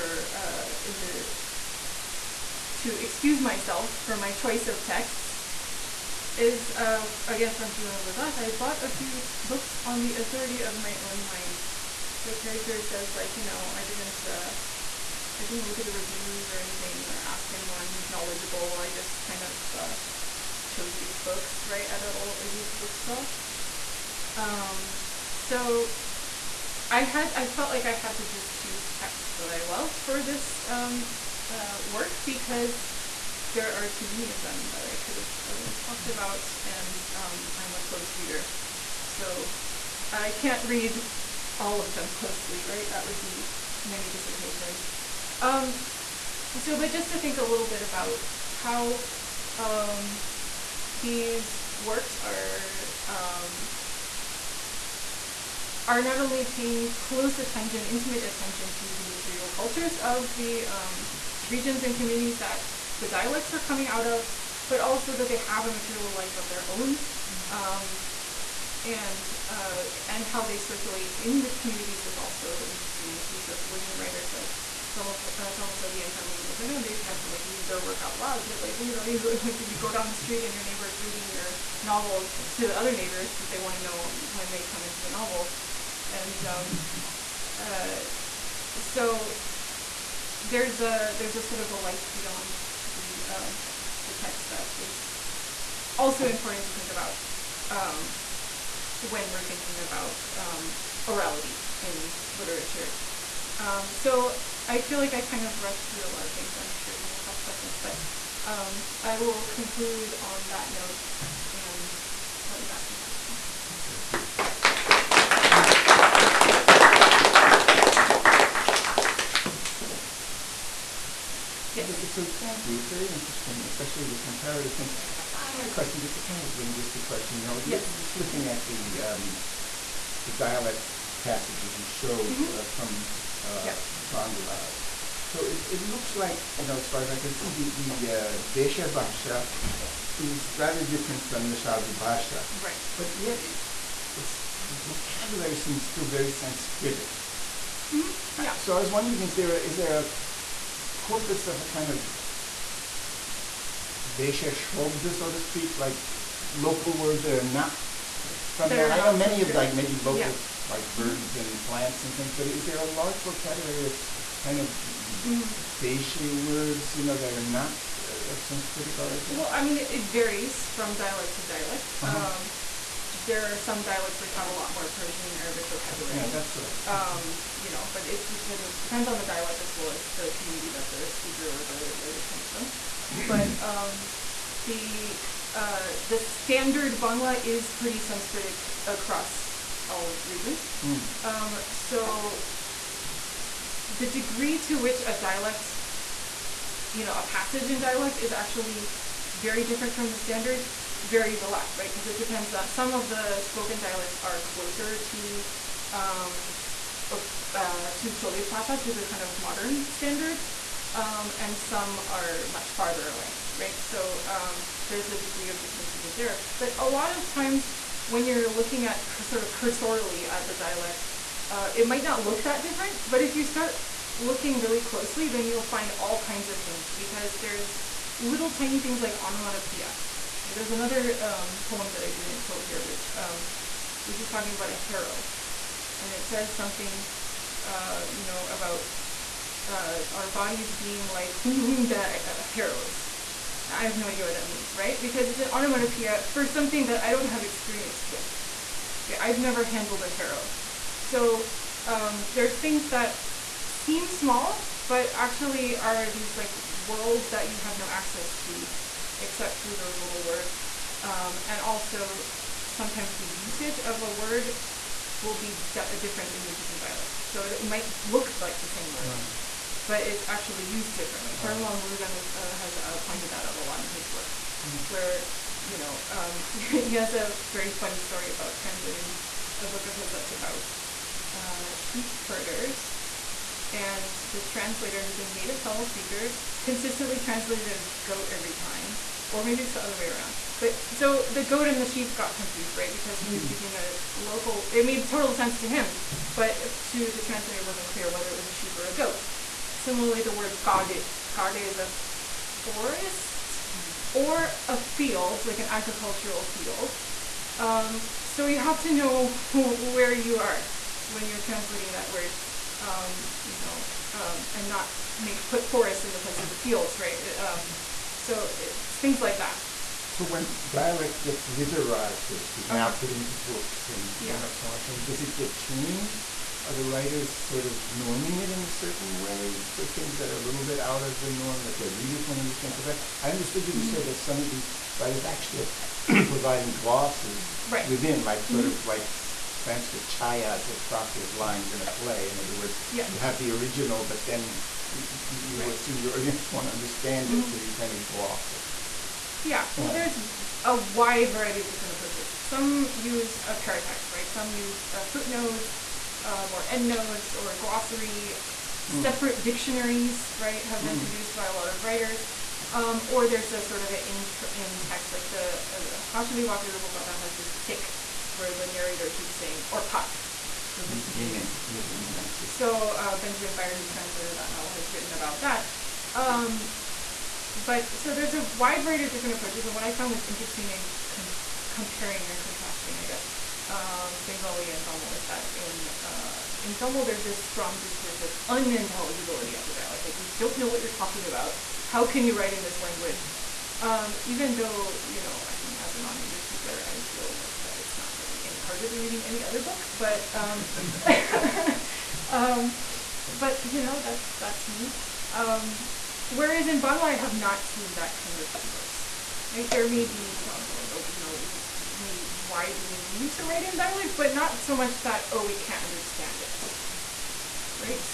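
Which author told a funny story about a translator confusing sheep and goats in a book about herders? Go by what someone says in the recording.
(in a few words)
Perumal Murugan.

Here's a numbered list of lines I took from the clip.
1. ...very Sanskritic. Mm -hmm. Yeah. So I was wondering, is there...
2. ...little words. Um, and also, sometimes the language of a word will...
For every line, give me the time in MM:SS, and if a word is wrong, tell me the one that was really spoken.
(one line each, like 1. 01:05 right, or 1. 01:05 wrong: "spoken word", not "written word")
1. 02:26 right
2. 04:20 wrong: "usage", not "language".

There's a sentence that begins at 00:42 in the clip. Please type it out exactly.
Right, that would be many dissertations.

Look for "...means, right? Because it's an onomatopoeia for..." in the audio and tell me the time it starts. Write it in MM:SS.
04:04.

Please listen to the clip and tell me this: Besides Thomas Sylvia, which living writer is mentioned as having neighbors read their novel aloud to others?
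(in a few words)
Kanmani Gunasekaran.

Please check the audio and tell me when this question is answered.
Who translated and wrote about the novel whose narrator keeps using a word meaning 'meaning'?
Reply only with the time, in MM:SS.
06:13.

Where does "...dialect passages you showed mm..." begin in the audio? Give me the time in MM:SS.
02:10.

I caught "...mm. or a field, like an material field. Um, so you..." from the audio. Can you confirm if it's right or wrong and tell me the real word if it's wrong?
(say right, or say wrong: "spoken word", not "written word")
wrong: "agricultural", not "material".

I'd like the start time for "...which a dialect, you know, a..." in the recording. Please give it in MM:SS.
03:14.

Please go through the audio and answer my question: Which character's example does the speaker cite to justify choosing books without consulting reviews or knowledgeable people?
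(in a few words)
Jivan.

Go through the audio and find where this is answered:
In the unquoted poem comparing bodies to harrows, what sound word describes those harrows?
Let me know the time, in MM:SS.
04:01.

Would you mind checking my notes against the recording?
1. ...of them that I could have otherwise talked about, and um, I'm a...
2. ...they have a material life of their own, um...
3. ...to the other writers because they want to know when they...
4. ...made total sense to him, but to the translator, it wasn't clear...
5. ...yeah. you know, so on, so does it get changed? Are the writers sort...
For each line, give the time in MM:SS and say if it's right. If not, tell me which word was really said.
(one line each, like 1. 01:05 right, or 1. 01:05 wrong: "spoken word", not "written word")
1. 00:34 right
2. 01:05 right
3. 01:22 wrong: "neighbors", not "writers"
4. 04:54 right
5. 05:24 right.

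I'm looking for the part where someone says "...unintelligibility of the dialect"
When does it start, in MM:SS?
06:28.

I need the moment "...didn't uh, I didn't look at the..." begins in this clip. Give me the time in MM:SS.
00:13.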